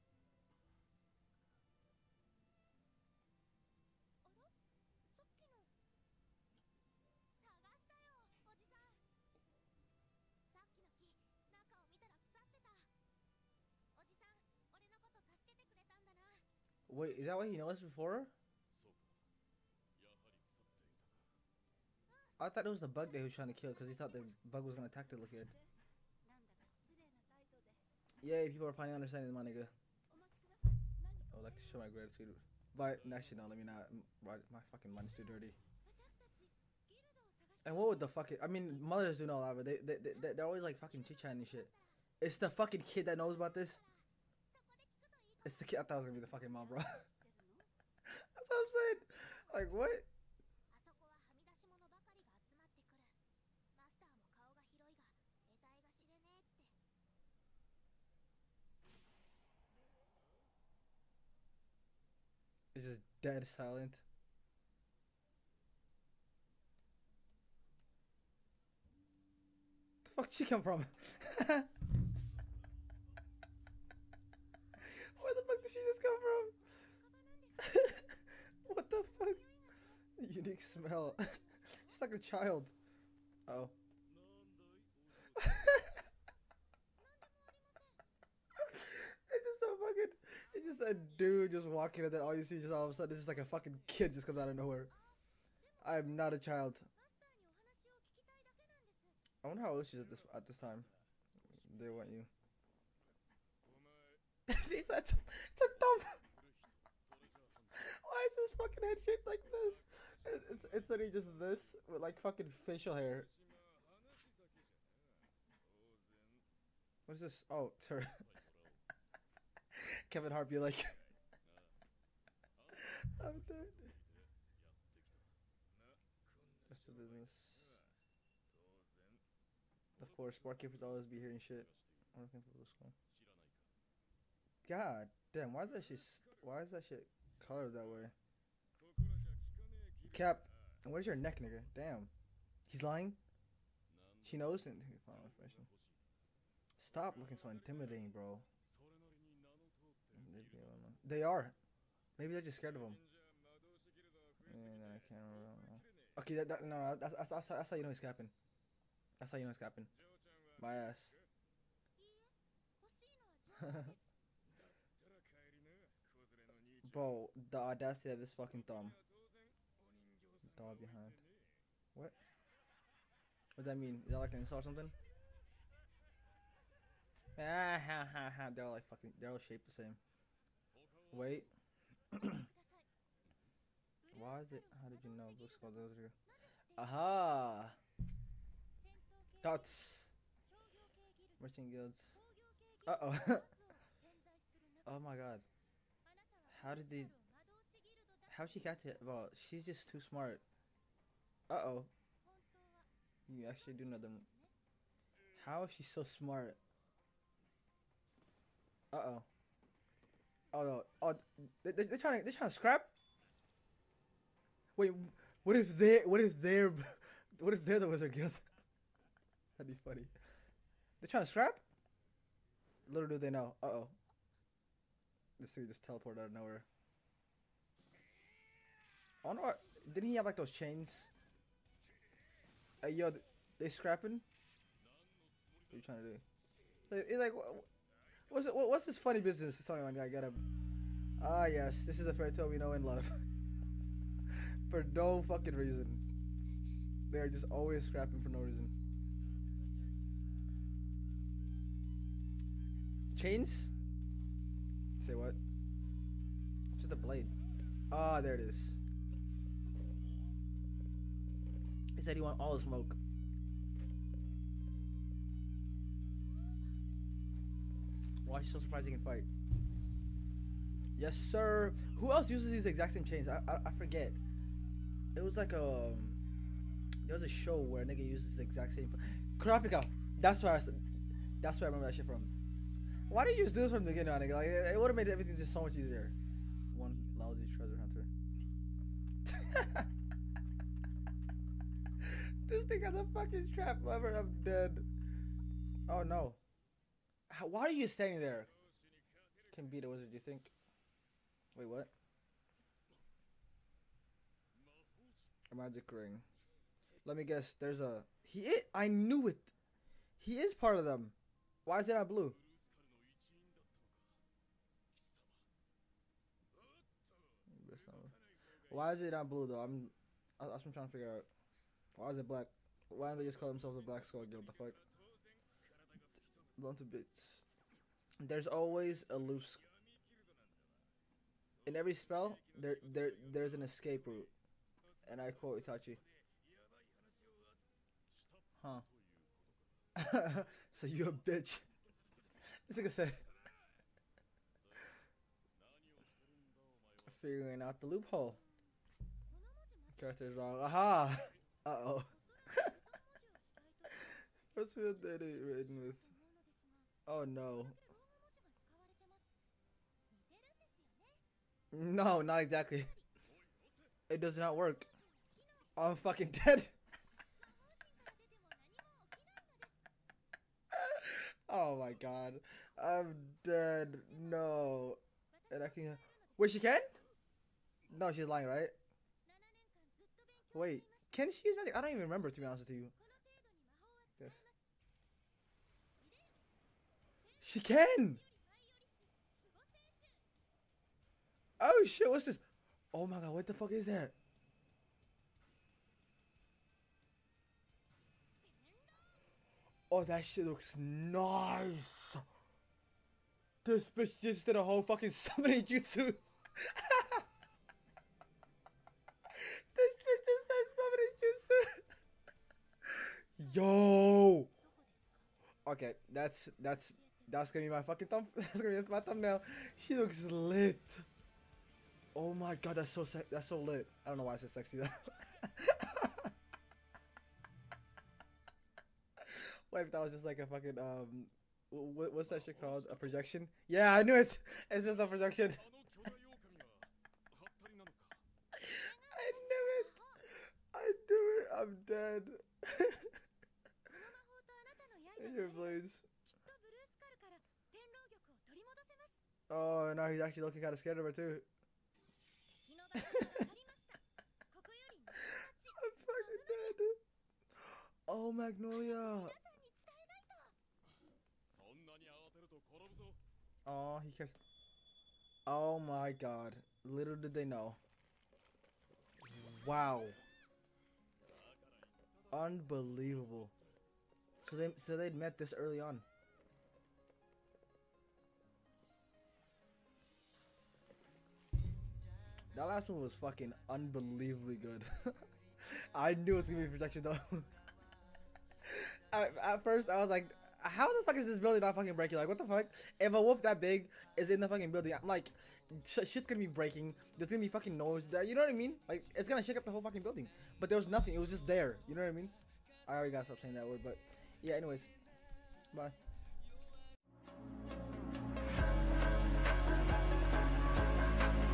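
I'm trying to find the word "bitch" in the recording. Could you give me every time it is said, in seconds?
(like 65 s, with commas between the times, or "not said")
341 s, 403 s.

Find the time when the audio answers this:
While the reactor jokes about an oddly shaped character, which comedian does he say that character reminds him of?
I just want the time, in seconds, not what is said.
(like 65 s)
120 s.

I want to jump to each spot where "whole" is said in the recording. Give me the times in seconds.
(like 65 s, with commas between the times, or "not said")
404 s, 499 s.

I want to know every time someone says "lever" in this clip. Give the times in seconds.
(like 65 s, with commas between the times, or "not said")
293 s.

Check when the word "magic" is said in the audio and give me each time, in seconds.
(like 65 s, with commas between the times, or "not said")
305 s, 381 s.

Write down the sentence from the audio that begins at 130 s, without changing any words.
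Of course, barkeepers always be hearing shit.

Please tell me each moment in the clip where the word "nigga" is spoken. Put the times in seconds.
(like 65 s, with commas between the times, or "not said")
29 s, 141 s, 277 s, 284 s, 342 s.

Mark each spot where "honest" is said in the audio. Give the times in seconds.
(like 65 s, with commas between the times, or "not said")
382 s.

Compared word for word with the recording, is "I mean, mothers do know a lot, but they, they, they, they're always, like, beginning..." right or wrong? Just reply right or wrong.
wrong.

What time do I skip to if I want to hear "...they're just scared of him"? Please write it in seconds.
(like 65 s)
152 s.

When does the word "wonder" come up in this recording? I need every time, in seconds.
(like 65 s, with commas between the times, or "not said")
99 s, 229 s.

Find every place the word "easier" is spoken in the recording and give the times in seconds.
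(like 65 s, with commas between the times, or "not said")
285 s.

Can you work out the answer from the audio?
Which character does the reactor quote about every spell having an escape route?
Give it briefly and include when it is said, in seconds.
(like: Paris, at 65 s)
Itachi, at 335 s.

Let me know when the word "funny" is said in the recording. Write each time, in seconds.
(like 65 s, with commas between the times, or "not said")
219 s, 238 s.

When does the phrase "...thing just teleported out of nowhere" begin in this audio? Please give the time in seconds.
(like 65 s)
225 s.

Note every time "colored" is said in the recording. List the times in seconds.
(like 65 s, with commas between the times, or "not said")
137 s.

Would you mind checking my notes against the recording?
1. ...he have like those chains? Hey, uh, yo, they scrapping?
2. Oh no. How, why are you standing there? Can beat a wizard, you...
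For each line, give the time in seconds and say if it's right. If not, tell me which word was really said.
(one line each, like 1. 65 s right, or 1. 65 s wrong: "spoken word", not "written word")
1. 230 s right
2. 295 s right.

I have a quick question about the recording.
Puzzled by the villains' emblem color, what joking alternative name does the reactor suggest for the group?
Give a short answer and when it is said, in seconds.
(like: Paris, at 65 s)
Black Skull Guild, at 323 s.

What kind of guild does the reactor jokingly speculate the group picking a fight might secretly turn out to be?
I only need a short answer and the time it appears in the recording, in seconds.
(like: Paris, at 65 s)
Wizard Guild, at 217 s.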